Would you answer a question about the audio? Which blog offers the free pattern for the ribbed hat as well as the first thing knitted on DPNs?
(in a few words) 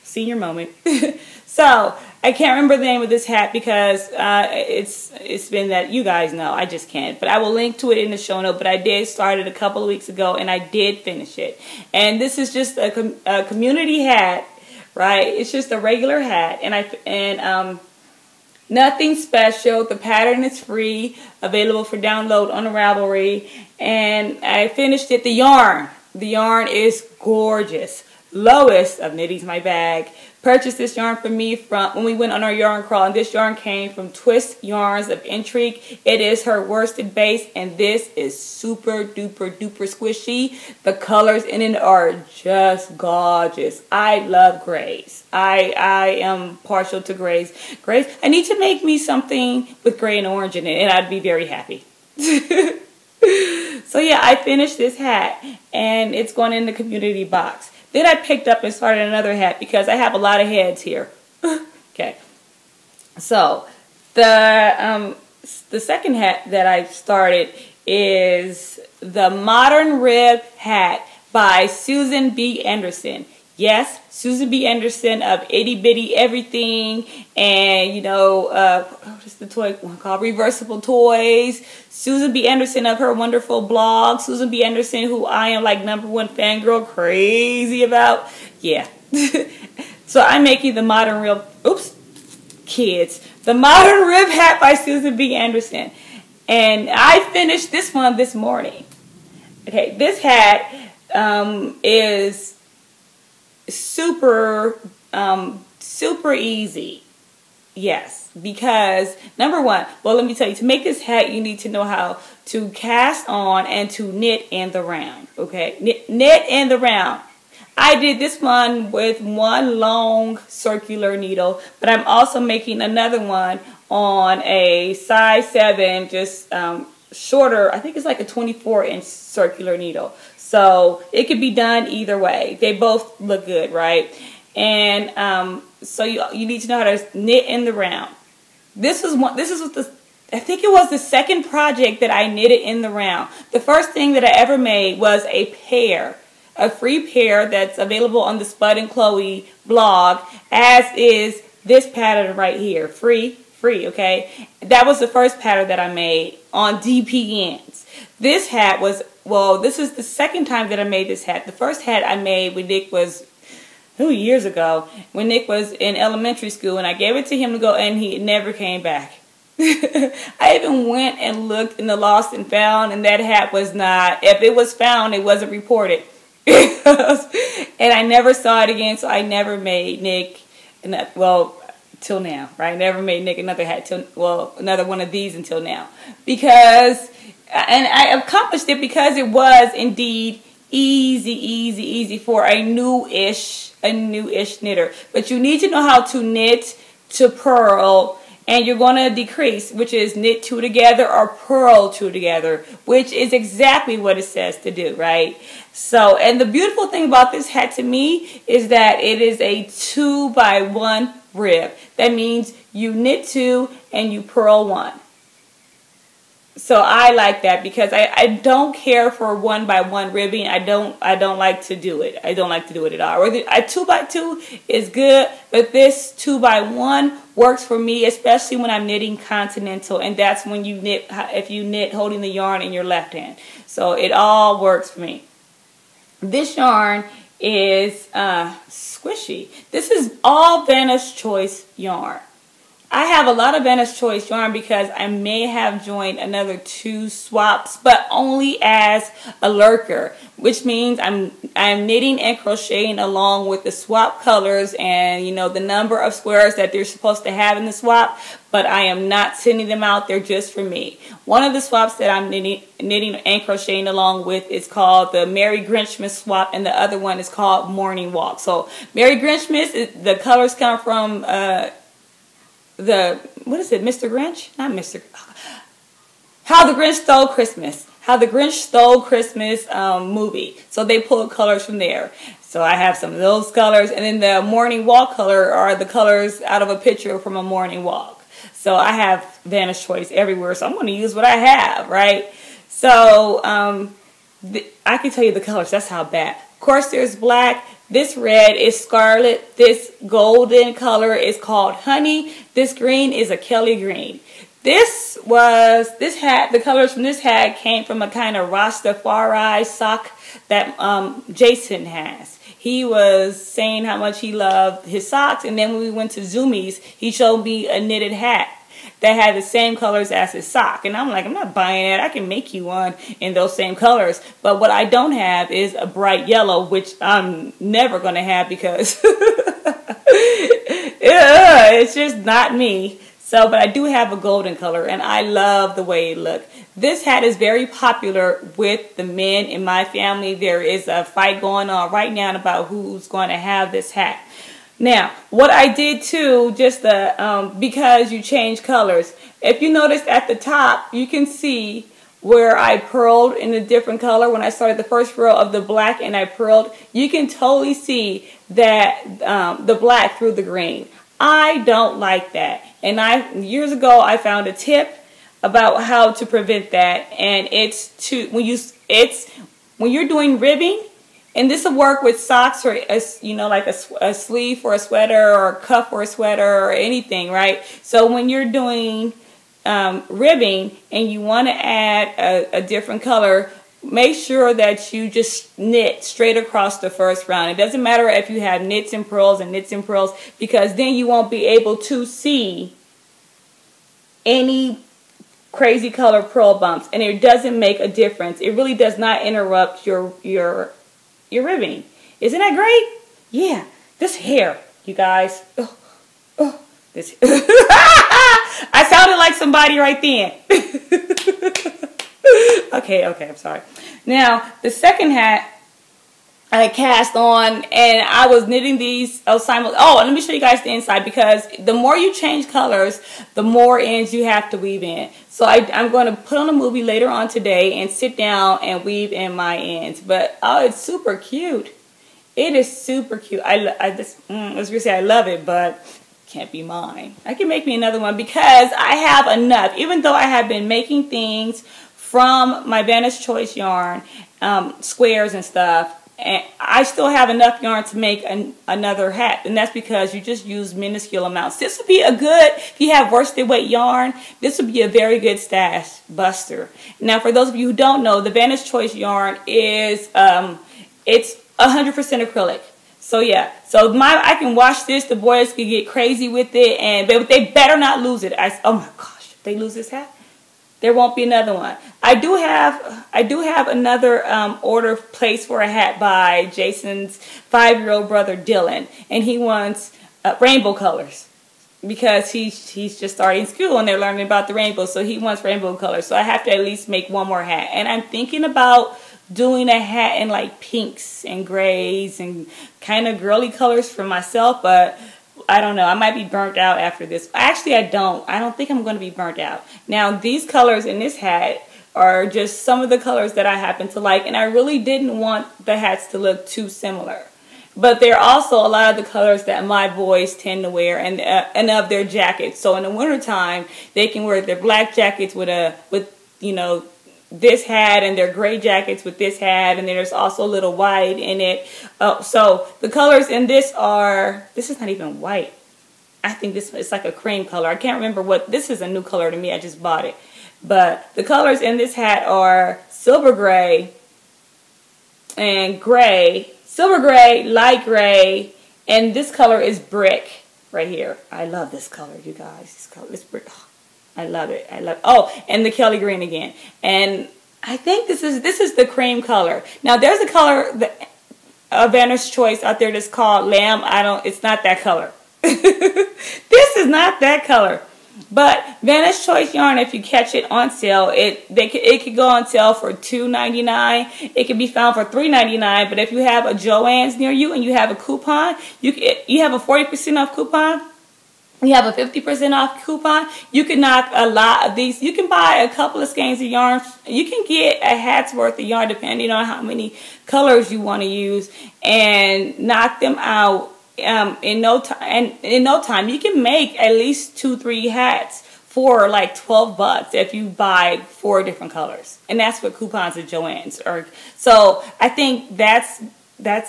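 Spud and Chloe.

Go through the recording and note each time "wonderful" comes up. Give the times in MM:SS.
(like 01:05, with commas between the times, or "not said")
01:23.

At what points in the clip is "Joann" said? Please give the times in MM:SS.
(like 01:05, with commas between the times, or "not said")
09:26, 09:53.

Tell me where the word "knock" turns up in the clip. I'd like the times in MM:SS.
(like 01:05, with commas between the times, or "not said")
09:33, 09:42.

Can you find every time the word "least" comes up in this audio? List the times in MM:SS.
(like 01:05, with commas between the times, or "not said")
08:06, 09:46.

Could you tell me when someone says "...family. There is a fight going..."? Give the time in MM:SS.
05:39.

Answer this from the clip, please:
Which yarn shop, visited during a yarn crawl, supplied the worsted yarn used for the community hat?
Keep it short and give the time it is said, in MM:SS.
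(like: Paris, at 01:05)
Twist Yarns of Intrigue, at 00:34.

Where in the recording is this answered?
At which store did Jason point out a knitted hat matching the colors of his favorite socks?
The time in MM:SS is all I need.
05:16.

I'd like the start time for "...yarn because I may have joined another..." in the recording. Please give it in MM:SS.
04:04.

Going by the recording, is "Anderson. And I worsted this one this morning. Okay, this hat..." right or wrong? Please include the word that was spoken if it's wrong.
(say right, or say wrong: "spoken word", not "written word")
wrong: "finished", not "worsted".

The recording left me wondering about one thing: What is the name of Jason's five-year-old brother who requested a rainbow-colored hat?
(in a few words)
Dylan.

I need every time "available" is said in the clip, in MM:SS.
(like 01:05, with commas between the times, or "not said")
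00:21, 02:27.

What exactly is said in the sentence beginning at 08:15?
I might be burnt out after this.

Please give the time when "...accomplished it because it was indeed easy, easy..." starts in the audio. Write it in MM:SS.
03:08.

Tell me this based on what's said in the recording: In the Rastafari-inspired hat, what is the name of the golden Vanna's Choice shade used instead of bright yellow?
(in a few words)
honey.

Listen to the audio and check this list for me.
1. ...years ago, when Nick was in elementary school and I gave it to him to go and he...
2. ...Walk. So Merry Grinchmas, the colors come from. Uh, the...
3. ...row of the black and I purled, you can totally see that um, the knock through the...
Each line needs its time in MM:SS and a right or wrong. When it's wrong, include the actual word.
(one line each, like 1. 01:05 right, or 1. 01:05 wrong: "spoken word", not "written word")
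1. 02:44 right
2. 04:28 right
3. 05:55 wrong: "black", not "knock".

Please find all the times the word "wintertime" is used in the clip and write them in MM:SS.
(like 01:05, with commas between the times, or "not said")
08:32.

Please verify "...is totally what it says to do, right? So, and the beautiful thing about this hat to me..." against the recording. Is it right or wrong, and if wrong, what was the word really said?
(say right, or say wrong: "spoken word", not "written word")
wrong: "exactly", not "totally".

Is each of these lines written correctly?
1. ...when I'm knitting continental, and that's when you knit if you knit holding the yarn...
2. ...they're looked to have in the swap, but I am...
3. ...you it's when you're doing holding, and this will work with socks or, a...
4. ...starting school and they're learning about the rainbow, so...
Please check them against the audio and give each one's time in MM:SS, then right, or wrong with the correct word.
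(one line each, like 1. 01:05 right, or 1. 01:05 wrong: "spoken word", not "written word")
1. 03:48 right
2. 04:16 wrong: "supposed", not "looked"
3. 06:08 wrong: "ribbing", not "holding"
4. 08:03 right.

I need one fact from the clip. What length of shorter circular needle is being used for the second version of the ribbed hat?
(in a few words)
24 inch.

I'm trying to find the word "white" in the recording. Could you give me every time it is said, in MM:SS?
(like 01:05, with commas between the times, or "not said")
08:40, 08:45.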